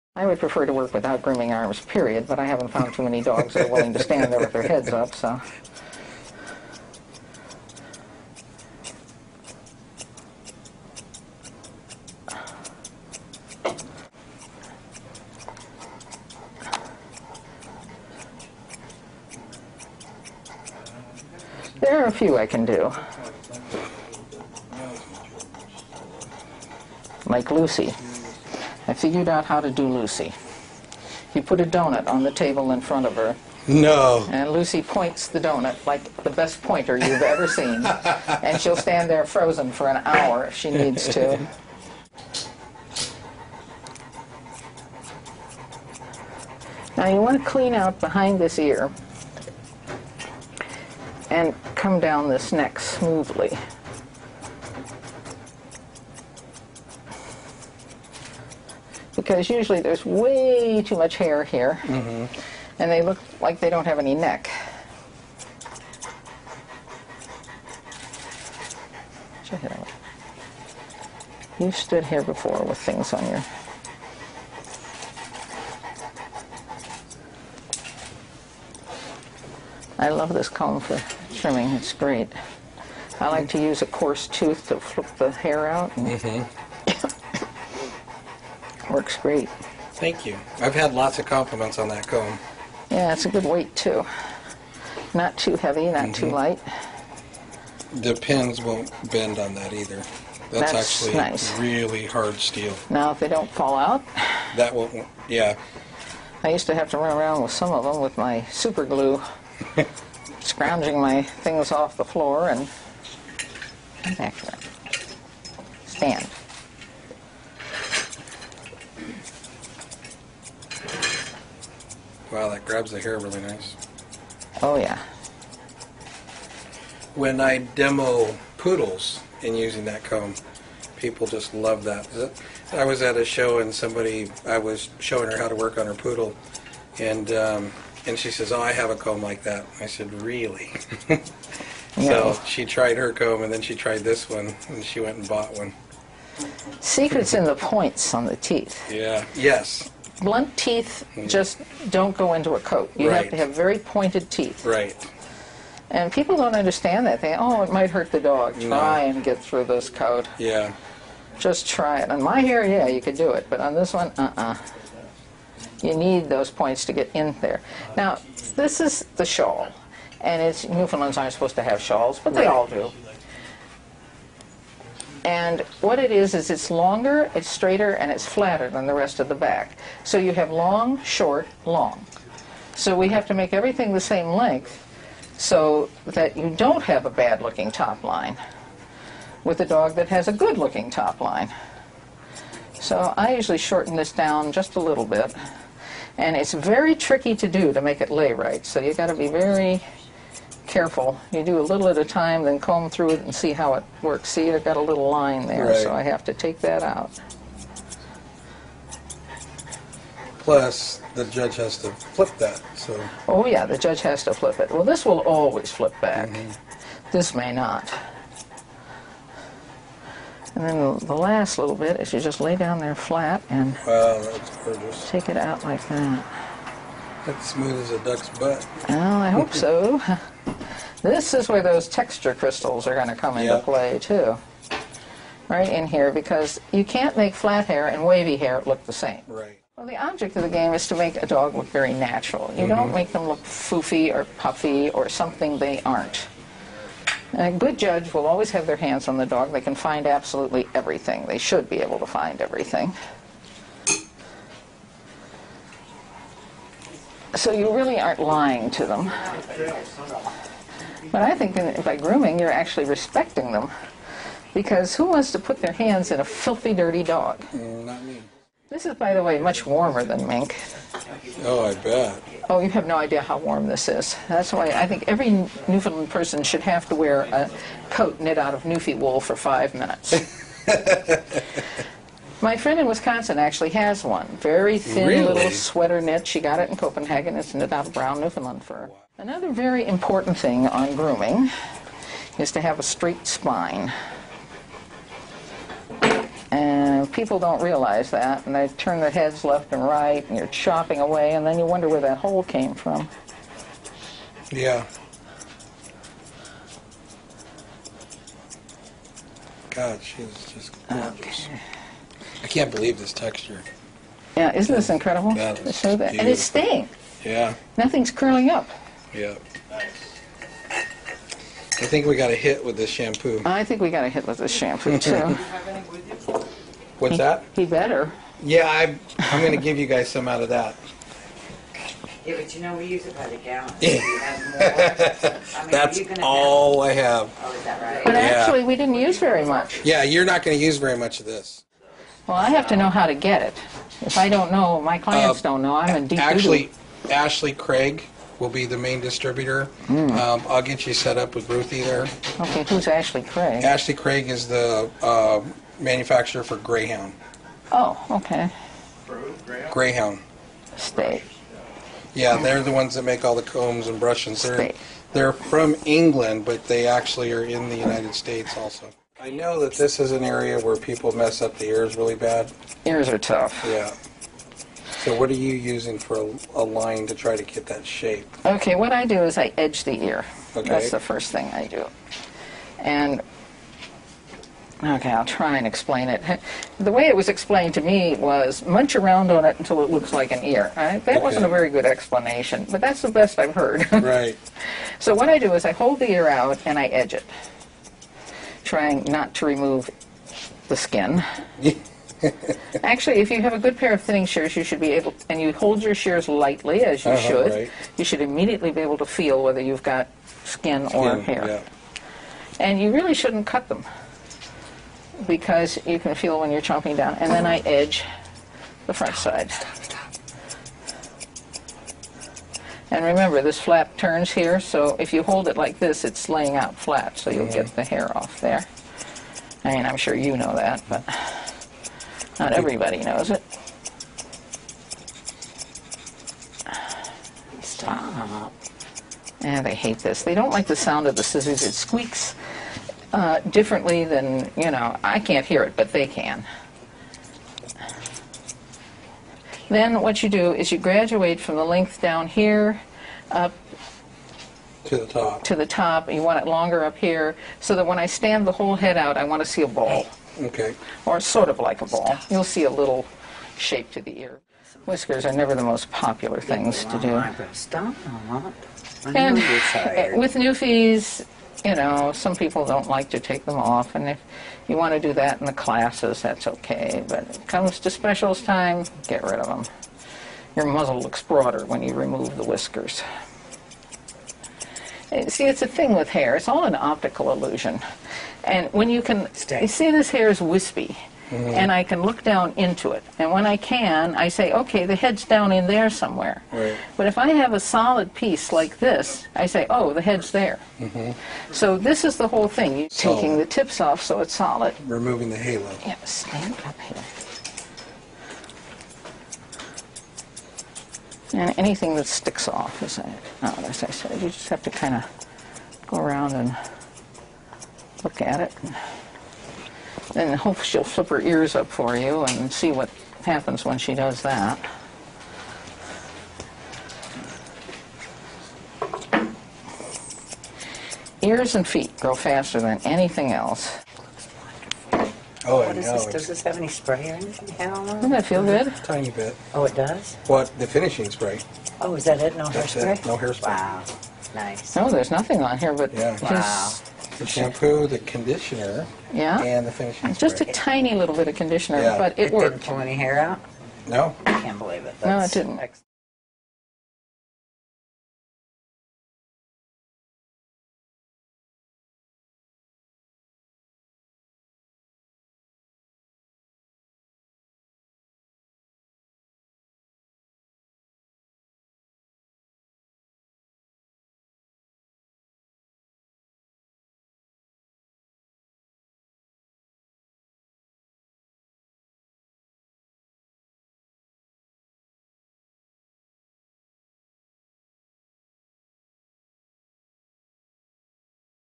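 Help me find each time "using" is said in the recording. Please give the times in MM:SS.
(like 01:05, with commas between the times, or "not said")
02:09, 06:15.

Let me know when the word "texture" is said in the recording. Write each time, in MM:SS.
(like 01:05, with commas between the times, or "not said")
03:51, 05:13.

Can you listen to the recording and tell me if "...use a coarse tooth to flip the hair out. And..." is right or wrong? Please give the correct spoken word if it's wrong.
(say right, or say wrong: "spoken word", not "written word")
right.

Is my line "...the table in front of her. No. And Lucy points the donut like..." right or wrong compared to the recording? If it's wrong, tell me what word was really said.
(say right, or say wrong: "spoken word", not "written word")
right.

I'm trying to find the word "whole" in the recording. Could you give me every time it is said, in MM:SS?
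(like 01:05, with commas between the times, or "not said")
07:38, 08:22.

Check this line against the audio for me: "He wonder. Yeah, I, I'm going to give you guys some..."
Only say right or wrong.
wrong.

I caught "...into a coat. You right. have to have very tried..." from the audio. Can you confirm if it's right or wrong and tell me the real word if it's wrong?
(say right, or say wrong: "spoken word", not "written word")
wrong: "pointed", not "tried".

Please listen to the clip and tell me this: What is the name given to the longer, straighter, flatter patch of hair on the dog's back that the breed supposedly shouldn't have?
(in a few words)
The shawl.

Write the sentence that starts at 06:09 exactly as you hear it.
I know that this is an area where people mess up the ears really bad.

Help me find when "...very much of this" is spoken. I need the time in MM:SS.
05:40.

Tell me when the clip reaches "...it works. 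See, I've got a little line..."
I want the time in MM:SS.
03:23.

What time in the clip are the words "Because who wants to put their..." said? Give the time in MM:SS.
04:24.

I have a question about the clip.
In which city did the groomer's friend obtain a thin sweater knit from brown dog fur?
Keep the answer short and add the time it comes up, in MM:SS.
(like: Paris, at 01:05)
Copenhagen, at 04:46.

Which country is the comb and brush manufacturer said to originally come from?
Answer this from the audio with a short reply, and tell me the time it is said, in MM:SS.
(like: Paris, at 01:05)
England, at 06:05.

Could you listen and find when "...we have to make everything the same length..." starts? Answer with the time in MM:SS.
03:02.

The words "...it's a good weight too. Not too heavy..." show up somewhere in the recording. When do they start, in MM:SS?
01:33.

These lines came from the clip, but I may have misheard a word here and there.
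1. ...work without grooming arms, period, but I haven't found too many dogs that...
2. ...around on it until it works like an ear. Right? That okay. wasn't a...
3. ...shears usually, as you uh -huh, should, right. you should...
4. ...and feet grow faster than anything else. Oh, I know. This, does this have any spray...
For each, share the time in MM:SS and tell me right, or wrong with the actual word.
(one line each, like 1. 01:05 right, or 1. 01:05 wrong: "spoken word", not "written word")
1. 00:00 right
2. 06:28 wrong: "looks", not "works"
3. 06:45 wrong: "lightly", not "usually"
4. 08:51 right.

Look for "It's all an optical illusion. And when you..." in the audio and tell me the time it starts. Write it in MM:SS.
08:06.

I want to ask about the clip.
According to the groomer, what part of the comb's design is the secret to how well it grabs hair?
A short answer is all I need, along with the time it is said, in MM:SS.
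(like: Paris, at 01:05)
The points on the teeth, at 02:27.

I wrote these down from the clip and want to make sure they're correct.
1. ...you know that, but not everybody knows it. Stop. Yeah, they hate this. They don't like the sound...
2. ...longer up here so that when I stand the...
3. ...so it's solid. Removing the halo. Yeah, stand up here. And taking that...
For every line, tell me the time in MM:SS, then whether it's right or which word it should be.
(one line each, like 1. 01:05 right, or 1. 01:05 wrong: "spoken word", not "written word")
1. 07:10 right
2. 07:36 right
3. 08:24 wrong: "anything", not "taking".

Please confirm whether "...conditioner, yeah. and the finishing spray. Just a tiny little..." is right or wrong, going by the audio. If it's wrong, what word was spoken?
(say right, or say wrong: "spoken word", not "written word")
right.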